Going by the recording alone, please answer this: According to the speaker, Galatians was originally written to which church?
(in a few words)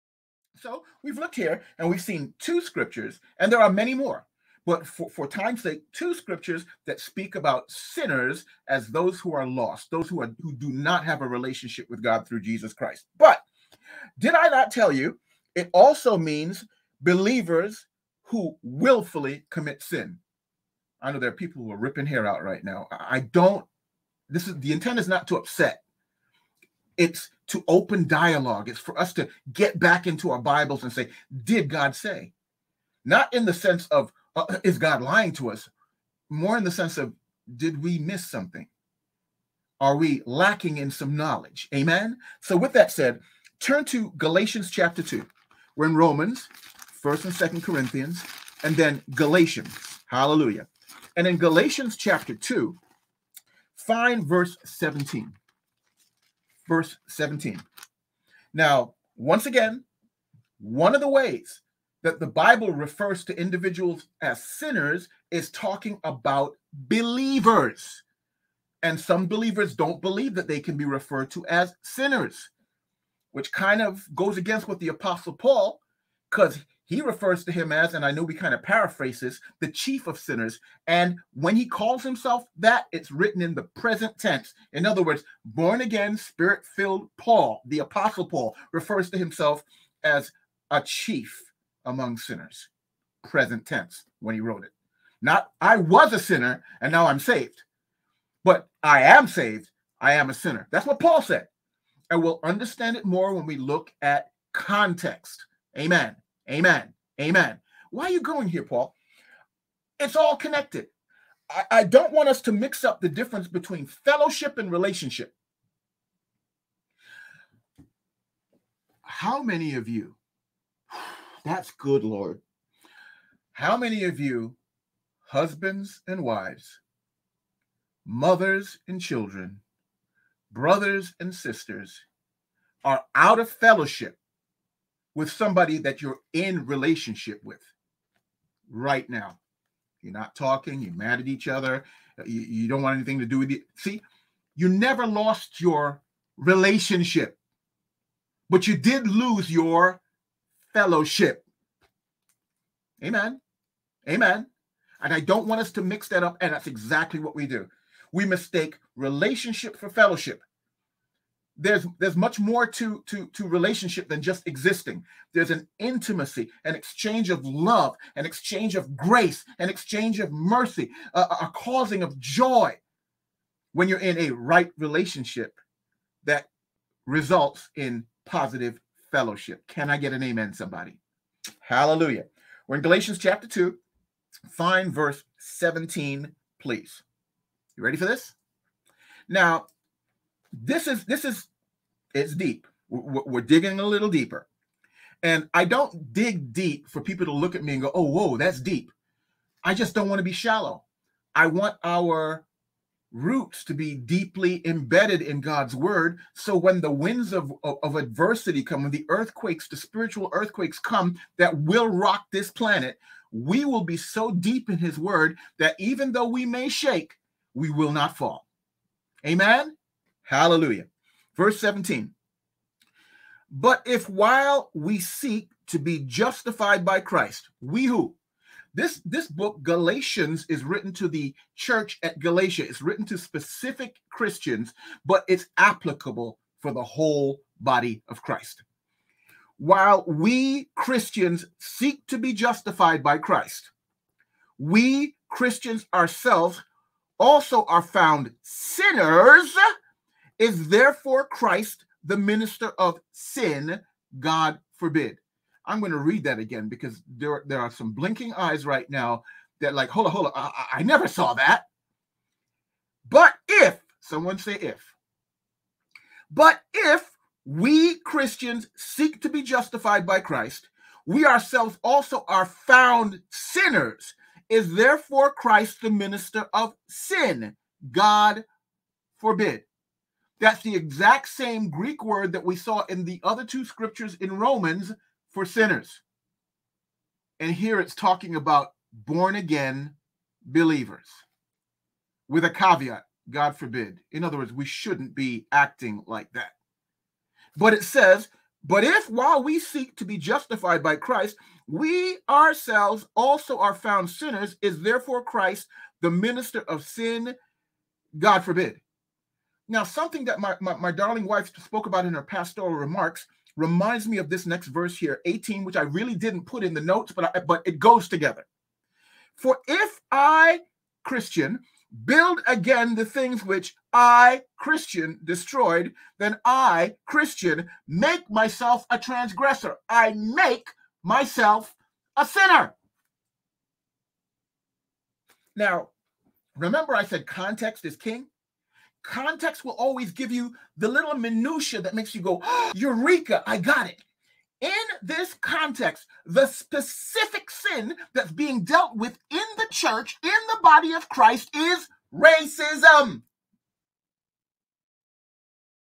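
the church at Galatia.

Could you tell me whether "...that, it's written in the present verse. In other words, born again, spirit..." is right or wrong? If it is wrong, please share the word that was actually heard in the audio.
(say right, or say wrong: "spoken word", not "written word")
wrong: "tense", not "verse".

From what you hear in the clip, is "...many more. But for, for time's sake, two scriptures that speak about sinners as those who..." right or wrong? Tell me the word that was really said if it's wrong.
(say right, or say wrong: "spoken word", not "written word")
right.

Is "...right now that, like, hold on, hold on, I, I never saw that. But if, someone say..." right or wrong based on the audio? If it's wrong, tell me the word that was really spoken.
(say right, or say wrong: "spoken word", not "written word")
right.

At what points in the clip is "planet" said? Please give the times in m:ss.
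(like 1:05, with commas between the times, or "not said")
3:32.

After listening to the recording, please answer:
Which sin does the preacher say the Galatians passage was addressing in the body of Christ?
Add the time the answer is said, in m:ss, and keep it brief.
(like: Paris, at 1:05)
racism, at 5:52.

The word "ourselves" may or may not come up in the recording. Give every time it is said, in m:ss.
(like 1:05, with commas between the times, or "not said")
4:05, 4:31, 5:02.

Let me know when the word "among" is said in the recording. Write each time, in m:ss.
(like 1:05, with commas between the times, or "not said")
1:31.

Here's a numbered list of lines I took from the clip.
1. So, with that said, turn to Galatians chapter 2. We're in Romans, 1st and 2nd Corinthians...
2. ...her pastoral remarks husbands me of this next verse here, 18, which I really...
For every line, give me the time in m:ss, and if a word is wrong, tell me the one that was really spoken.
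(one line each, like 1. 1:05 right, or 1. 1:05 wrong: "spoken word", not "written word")
1. 0:42 right
2. 5:12 wrong: "reminds", not "husbands".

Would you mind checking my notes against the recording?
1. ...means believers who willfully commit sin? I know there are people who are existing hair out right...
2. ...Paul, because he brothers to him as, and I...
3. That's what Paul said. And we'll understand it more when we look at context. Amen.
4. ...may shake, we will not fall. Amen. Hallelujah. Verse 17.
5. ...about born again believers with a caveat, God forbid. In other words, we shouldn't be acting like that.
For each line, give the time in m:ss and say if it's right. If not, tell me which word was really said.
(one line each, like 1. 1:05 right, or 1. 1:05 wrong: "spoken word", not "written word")
1. 0:16 wrong: "ripping", not "existing"
2. 1:15 wrong: "refers", not "brothers"
3. 1:40 right
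4. 3:36 right
5. 4:48 right.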